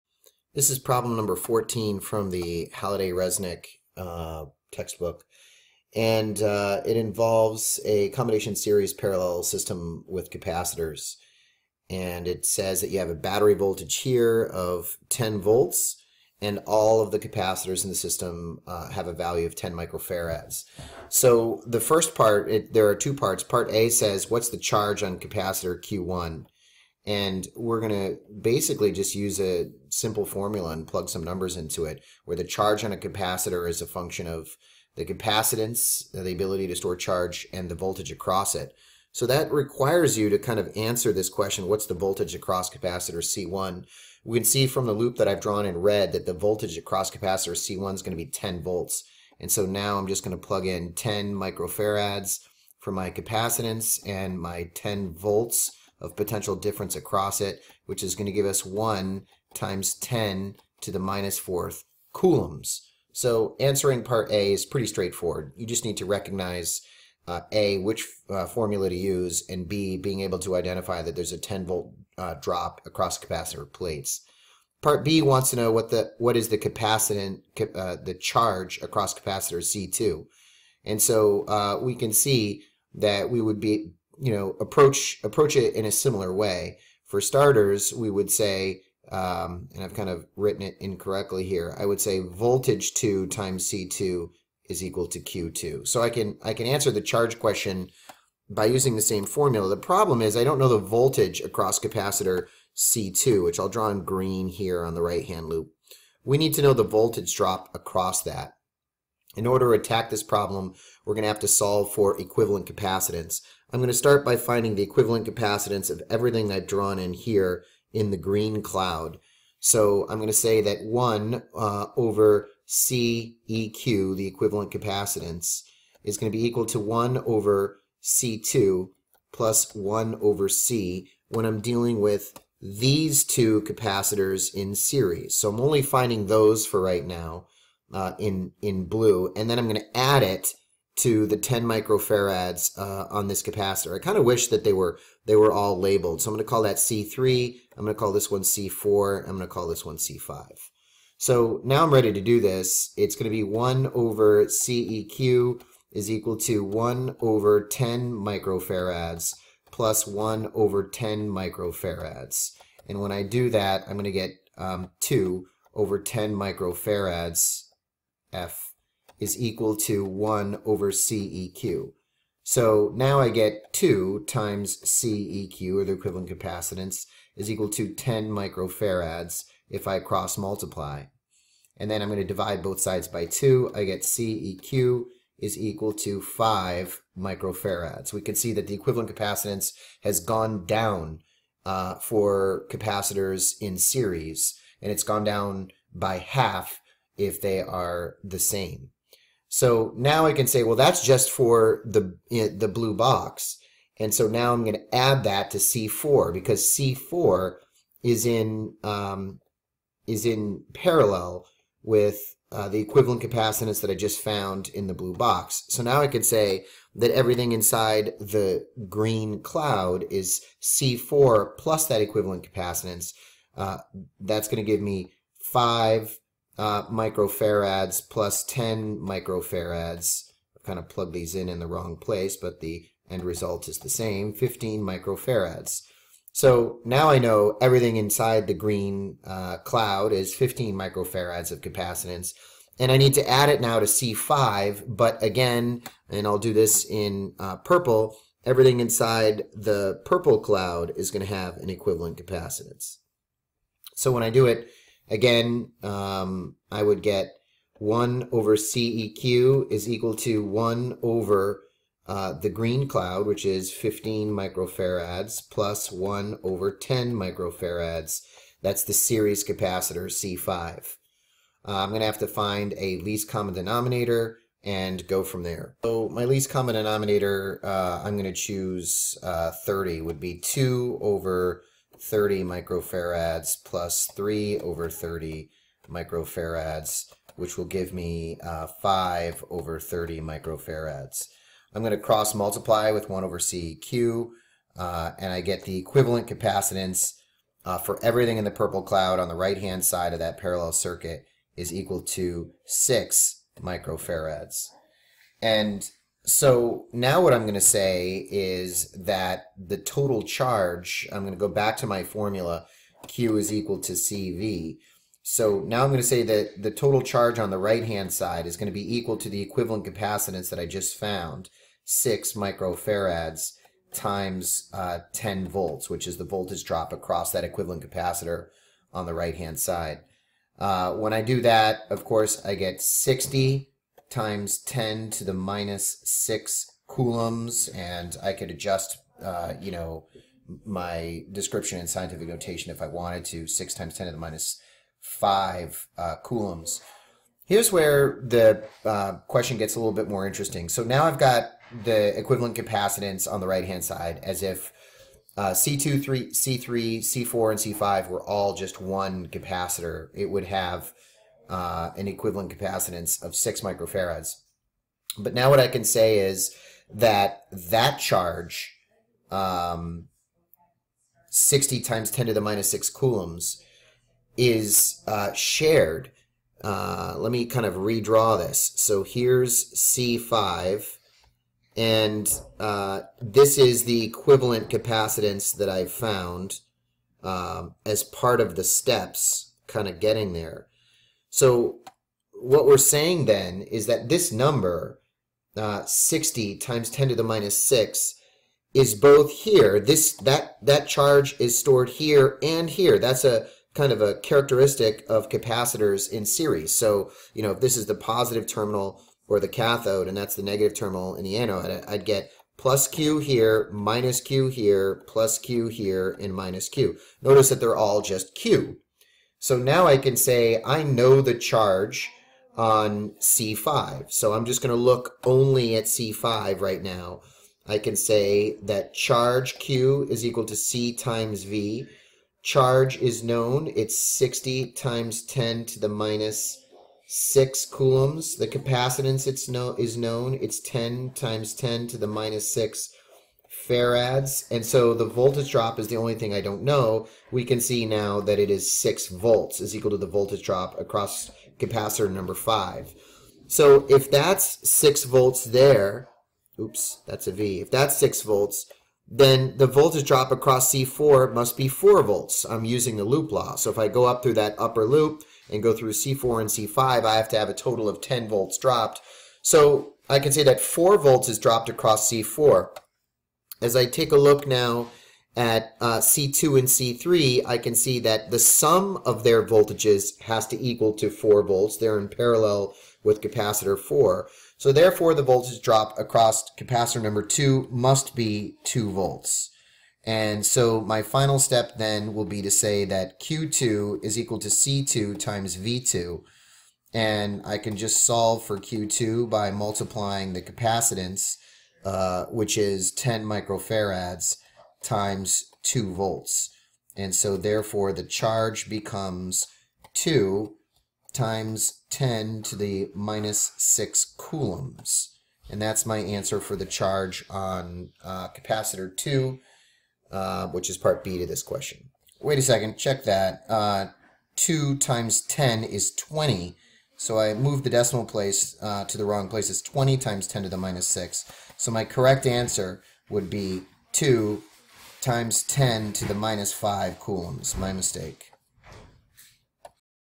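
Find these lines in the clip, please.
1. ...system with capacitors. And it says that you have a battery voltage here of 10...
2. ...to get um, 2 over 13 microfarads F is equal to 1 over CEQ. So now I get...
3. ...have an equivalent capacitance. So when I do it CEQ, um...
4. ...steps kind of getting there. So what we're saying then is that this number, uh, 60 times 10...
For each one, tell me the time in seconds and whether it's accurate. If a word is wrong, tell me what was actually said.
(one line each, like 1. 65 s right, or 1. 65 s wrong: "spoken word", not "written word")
1. 9 s right
2. 164 s wrong: "10", not "13"
3. 251 s wrong: "Again", not "CEQ"
4. 388 s right.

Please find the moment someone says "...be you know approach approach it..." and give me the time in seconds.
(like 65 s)
83 s.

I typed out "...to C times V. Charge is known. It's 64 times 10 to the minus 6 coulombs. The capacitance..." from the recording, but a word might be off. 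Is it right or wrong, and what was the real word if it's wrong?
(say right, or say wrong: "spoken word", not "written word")
wrong: "60", not "64".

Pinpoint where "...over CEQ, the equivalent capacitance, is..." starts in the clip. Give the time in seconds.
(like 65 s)
121 s.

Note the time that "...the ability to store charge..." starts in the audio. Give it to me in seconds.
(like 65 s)
36 s.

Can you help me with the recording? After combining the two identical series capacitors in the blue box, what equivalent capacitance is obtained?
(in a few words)
5 microfarads.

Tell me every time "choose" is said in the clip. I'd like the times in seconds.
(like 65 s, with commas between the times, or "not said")
278 s.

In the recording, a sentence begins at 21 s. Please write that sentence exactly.
So the first part, it, there are two parts.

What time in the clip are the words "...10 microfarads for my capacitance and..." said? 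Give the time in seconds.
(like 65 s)
50 s.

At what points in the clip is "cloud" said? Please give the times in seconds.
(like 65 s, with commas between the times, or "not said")
118 s, 219 s, 239 s, 250 s, 262 s, 298 s.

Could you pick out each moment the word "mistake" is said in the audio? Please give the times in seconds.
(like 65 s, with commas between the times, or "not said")
537 s.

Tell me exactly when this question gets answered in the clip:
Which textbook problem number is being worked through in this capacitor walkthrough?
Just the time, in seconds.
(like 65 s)
1 s.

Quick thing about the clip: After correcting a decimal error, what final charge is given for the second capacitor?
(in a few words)
2 × 10^-5 coulombs.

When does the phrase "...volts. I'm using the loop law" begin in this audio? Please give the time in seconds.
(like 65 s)
462 s.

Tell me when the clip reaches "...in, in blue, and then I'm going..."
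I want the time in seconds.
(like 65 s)
138 s.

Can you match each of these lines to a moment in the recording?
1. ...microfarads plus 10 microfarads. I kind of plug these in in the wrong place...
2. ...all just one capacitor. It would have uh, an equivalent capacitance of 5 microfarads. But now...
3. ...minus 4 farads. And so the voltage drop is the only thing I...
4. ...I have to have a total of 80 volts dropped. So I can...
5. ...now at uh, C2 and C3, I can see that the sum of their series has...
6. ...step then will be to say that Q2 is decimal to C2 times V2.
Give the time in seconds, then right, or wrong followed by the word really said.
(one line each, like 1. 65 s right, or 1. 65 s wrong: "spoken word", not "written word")
1. 226 s right
2. 358 s wrong: "6", not "5"
3. 442 s wrong: "6", not "4"
4. 467 s wrong: "10", not "80"
5. 474 s wrong: "voltages", not "series"
6. 491 s wrong: "equal", not "decimal".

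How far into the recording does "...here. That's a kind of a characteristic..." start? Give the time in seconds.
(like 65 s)
402 s.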